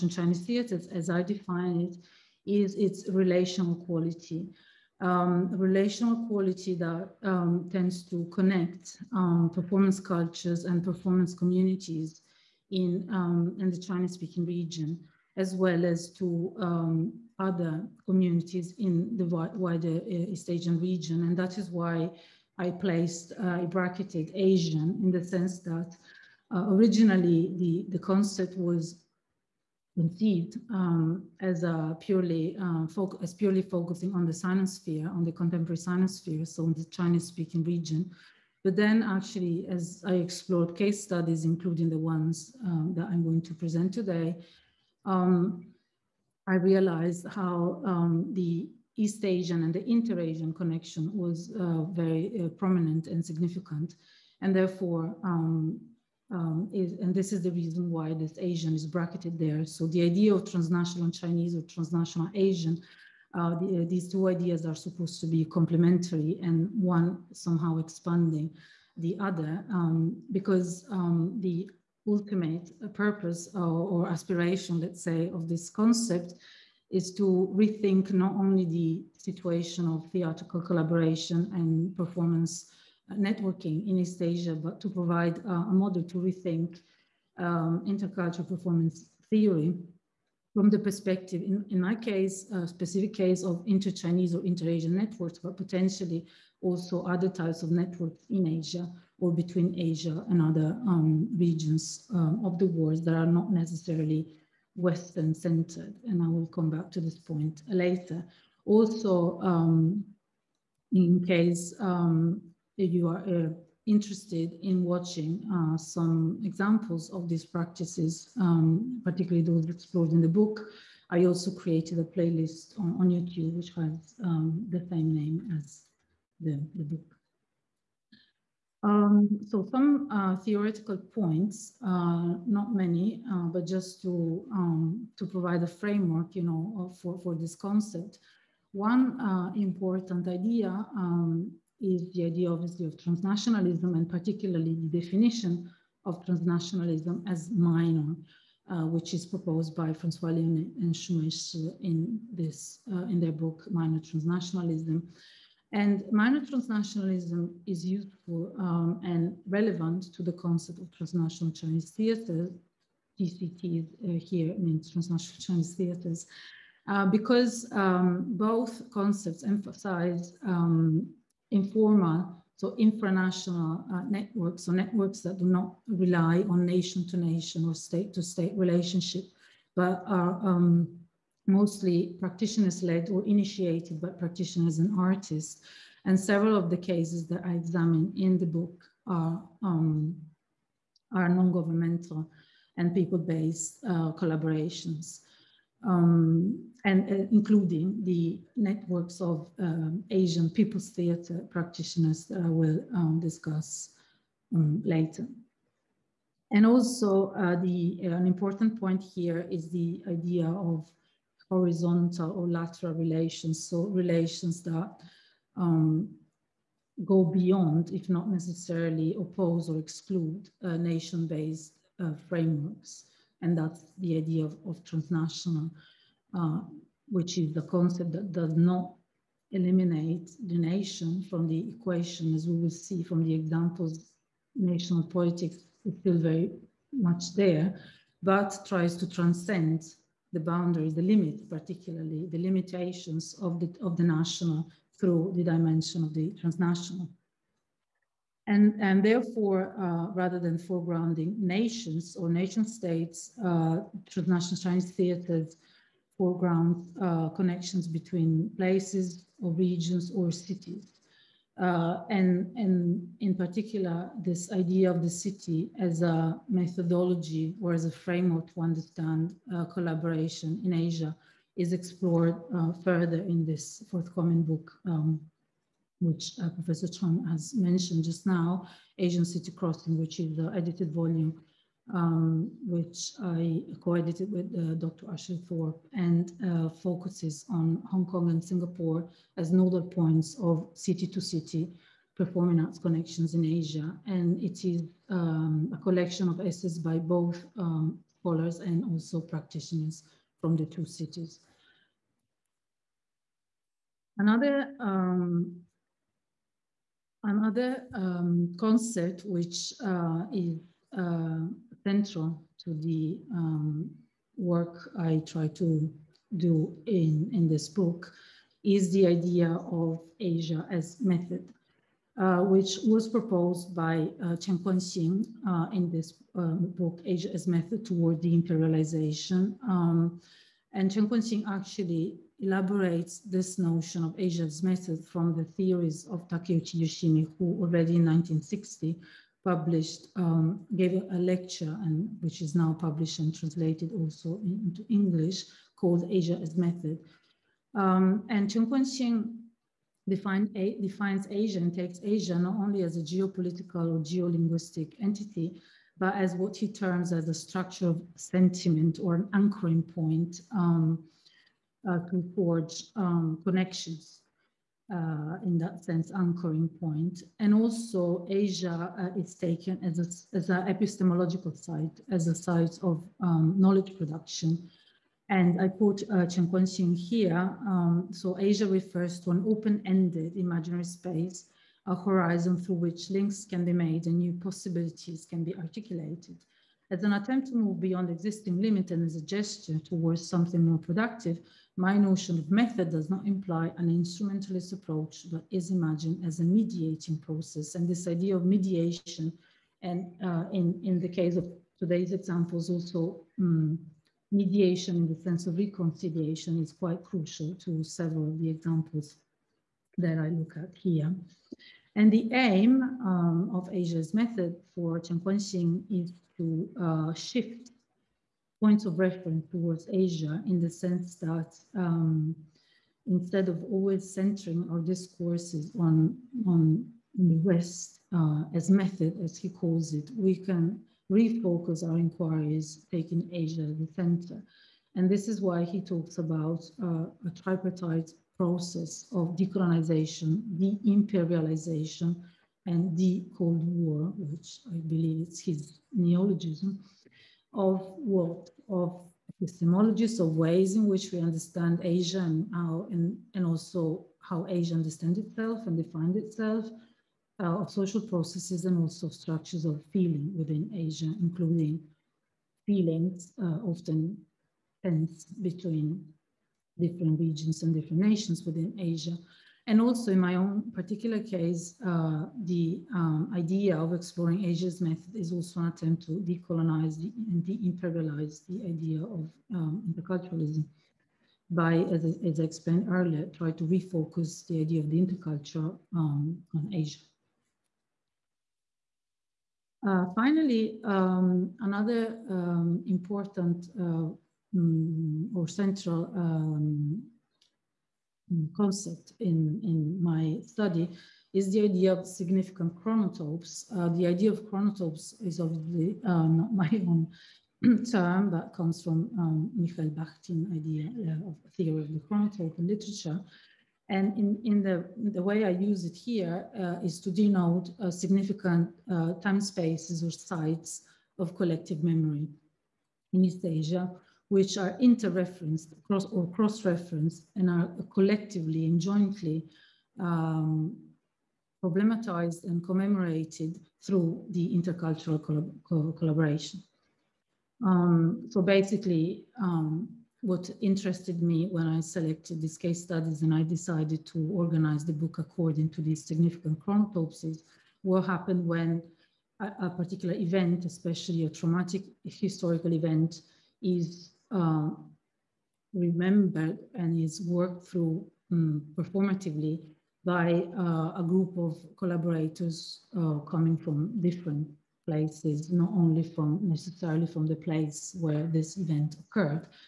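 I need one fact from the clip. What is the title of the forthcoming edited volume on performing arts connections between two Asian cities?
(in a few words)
Asian City Crossing.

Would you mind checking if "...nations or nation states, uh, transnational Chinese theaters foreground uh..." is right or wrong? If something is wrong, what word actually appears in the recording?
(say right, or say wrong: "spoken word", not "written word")
right.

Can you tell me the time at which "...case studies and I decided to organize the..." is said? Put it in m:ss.
9:02.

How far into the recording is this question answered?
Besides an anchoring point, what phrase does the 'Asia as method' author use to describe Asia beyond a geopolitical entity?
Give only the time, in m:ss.
5:57.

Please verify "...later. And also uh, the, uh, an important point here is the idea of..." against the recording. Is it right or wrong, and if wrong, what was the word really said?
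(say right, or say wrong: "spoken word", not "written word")
right.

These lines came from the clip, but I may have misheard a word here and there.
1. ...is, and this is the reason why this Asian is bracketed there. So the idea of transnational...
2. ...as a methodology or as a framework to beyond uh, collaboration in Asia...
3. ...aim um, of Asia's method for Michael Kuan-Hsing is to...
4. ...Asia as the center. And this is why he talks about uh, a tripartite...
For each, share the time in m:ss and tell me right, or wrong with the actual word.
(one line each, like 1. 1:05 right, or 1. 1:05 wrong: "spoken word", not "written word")
1. 0:56 right
2. 4:25 wrong: "understand", not "beyond"
3. 6:52 wrong: "Chen", not "Michael"
4. 7:13 right.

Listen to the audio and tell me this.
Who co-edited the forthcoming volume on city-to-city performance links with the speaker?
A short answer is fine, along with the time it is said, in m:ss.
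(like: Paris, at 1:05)
Ashley Thorpe, at 4:45.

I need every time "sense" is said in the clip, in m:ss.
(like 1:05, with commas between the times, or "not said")
0:25, 6:05, 6:45, 7:00.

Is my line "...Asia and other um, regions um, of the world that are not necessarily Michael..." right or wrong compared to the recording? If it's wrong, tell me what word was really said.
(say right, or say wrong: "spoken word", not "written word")
wrong: "Western", not "Michael".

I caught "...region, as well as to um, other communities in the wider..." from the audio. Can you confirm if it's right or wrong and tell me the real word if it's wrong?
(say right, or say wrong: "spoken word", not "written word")
right.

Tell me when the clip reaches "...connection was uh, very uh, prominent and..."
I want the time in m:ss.
0:50.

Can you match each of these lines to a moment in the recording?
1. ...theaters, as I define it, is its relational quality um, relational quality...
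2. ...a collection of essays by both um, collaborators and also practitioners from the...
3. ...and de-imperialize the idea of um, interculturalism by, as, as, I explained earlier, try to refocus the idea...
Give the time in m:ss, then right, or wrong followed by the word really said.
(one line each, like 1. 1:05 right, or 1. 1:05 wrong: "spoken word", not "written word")
1. 0:00 right
2. 4:55 wrong: "scholars", not "collaborators"
3. 7:56 right.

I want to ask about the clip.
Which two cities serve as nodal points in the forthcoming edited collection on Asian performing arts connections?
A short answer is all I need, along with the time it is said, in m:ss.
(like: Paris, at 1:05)
Hong Kong and Singapore, at 4:47.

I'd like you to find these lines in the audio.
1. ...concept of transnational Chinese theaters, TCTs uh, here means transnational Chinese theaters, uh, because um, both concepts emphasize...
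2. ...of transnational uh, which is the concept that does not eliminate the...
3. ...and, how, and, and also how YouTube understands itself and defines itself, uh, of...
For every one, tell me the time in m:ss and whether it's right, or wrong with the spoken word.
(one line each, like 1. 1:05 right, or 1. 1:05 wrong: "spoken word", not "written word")
1. 2:40 right
2. 3:44 right
3. 7:32 wrong: "Asia", not "YouTube".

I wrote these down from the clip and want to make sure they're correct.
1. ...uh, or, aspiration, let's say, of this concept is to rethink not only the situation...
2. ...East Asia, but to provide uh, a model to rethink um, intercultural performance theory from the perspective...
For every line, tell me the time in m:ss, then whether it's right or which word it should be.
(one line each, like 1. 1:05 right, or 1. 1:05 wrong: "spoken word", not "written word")
1. 1:13 right
2. 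1:23 right.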